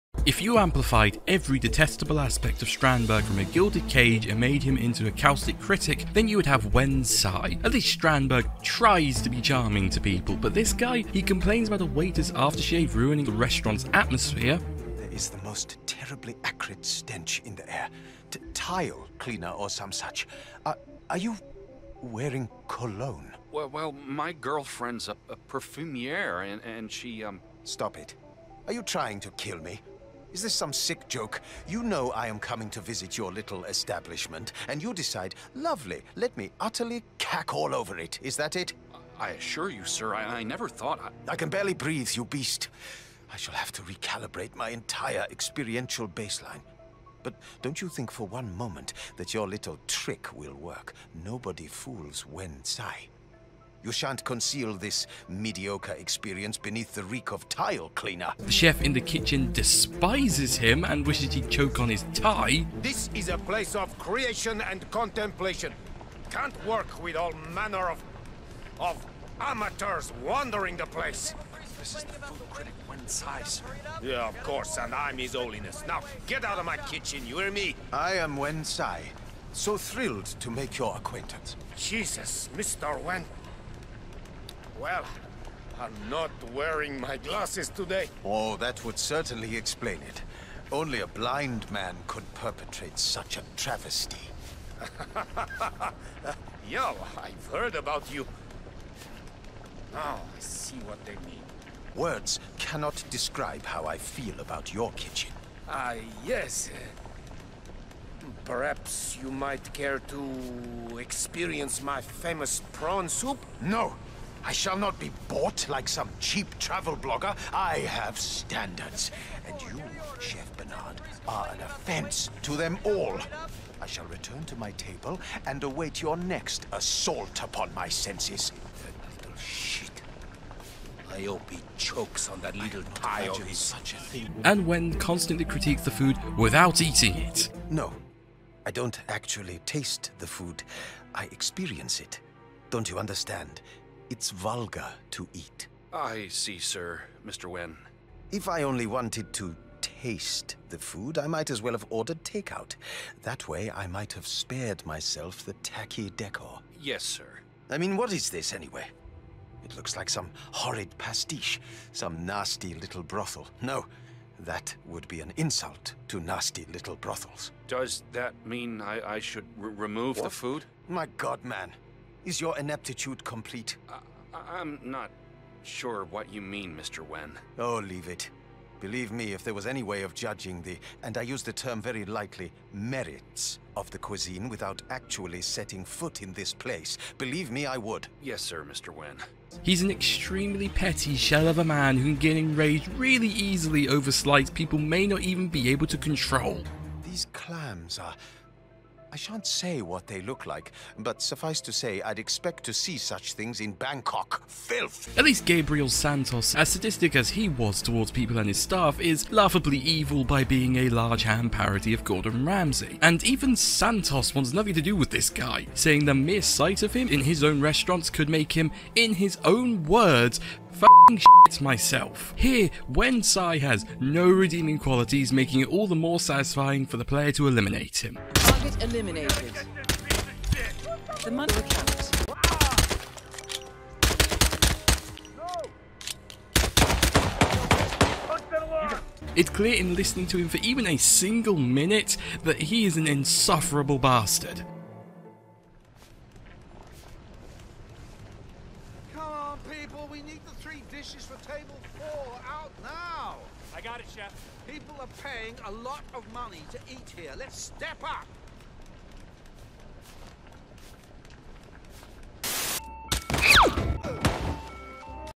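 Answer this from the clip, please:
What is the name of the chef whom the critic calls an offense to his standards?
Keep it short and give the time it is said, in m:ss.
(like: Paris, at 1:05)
Chef Bernard, at 2:00.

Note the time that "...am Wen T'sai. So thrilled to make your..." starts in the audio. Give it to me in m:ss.
1:18.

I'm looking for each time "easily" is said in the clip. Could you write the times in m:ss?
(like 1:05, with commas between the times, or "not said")
3:13.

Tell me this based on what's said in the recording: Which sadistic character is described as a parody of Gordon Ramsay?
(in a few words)
Gabriel Santos.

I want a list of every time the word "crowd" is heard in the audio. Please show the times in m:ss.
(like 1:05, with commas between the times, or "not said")
not said.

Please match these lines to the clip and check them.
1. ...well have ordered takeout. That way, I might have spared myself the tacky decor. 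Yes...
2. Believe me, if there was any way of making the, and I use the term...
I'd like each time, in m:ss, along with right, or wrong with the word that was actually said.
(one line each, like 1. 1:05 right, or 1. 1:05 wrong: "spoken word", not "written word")
1. 2:31 right
2. 2:58 wrong: "judging", not "making".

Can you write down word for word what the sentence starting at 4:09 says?
Well, we need the three dishes for table four out now.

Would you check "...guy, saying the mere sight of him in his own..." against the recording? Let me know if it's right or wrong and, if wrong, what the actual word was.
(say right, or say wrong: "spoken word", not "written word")
right.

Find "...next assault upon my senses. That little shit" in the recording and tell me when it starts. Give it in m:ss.
2:06.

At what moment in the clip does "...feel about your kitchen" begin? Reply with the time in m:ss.
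1:43.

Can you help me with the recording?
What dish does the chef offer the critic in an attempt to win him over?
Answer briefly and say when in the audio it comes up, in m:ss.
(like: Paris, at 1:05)
Prawn soup, at 1:52.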